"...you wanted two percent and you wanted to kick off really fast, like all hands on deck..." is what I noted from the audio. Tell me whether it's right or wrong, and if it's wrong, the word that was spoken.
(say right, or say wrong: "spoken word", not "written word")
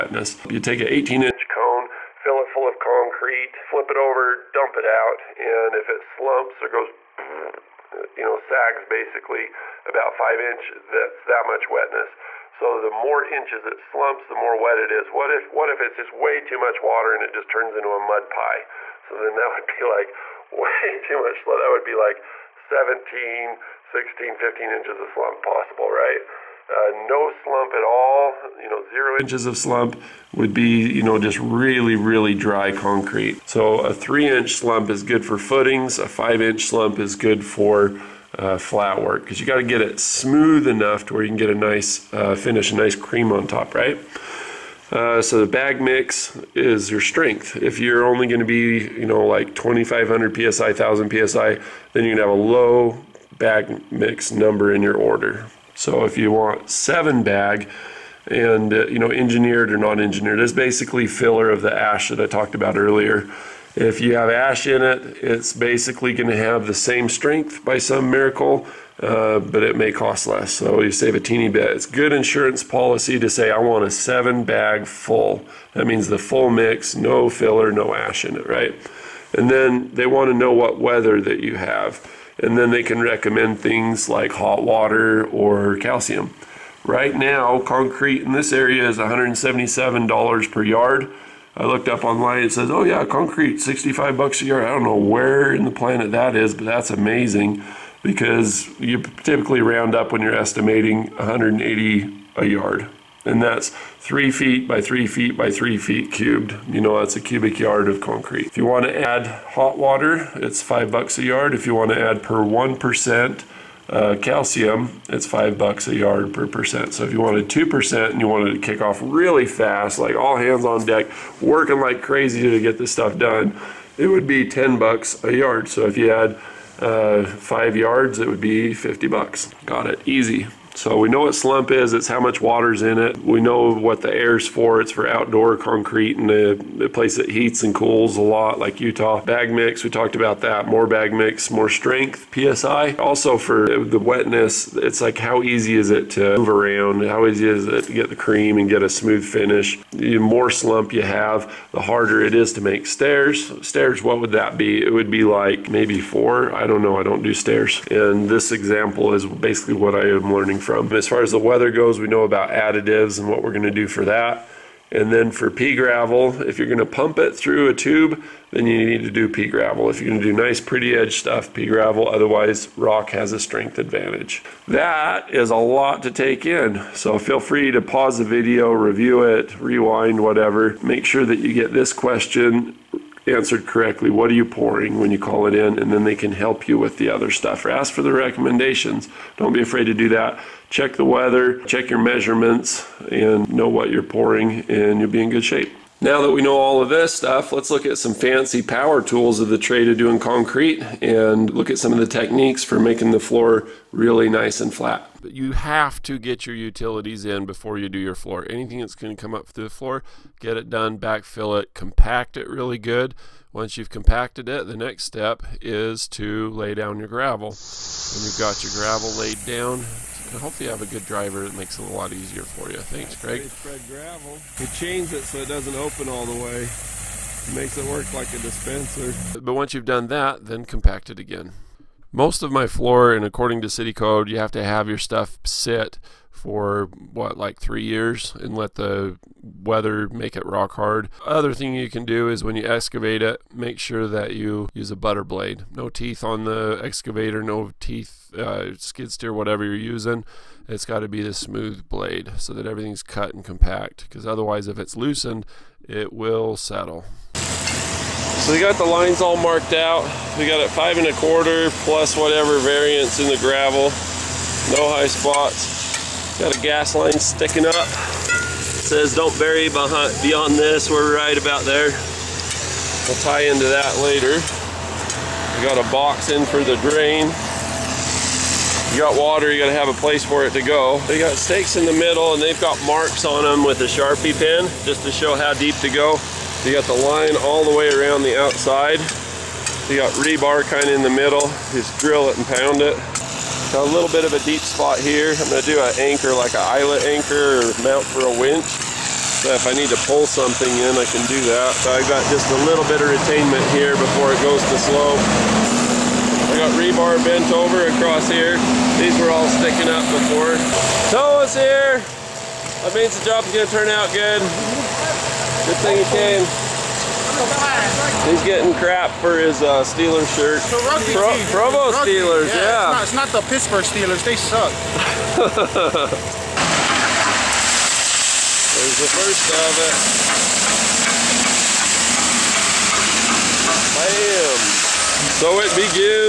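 right.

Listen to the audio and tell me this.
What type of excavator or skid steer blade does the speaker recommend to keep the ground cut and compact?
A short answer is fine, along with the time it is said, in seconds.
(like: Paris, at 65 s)
butter blade, at 244 s.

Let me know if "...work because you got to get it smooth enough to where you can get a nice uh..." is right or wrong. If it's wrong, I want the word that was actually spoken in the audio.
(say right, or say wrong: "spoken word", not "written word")
right.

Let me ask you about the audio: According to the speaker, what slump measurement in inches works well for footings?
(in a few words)
3 inches.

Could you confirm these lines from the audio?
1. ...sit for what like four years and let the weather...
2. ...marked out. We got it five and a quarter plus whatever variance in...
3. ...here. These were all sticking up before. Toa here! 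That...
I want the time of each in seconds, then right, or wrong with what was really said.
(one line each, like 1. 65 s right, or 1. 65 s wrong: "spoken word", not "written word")
1. 235 s wrong: "three", not "four"
2. 259 s right
3. 308 s right.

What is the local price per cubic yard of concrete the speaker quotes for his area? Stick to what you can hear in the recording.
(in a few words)
$177.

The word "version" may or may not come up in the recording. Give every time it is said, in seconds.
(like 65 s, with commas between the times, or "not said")
not said.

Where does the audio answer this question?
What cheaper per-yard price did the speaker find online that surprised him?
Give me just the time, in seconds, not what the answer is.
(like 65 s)
93 s.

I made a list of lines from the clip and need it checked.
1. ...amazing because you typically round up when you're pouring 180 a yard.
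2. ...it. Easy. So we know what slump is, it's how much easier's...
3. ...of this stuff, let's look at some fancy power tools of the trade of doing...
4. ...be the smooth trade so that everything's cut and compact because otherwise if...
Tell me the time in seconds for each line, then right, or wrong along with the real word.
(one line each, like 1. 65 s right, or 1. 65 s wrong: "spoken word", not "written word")
1. 96 s wrong: "estimating", not "pouring"
2. 129 s wrong: "water", not "easier"
3. 196 s right
4. 251 s wrong: "blade", not "trade".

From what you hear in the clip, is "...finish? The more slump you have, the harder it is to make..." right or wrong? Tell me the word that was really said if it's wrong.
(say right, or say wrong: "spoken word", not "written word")
right.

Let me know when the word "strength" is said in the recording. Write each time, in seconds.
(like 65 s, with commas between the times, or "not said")
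47 s, 67 s, 141 s, 173 s.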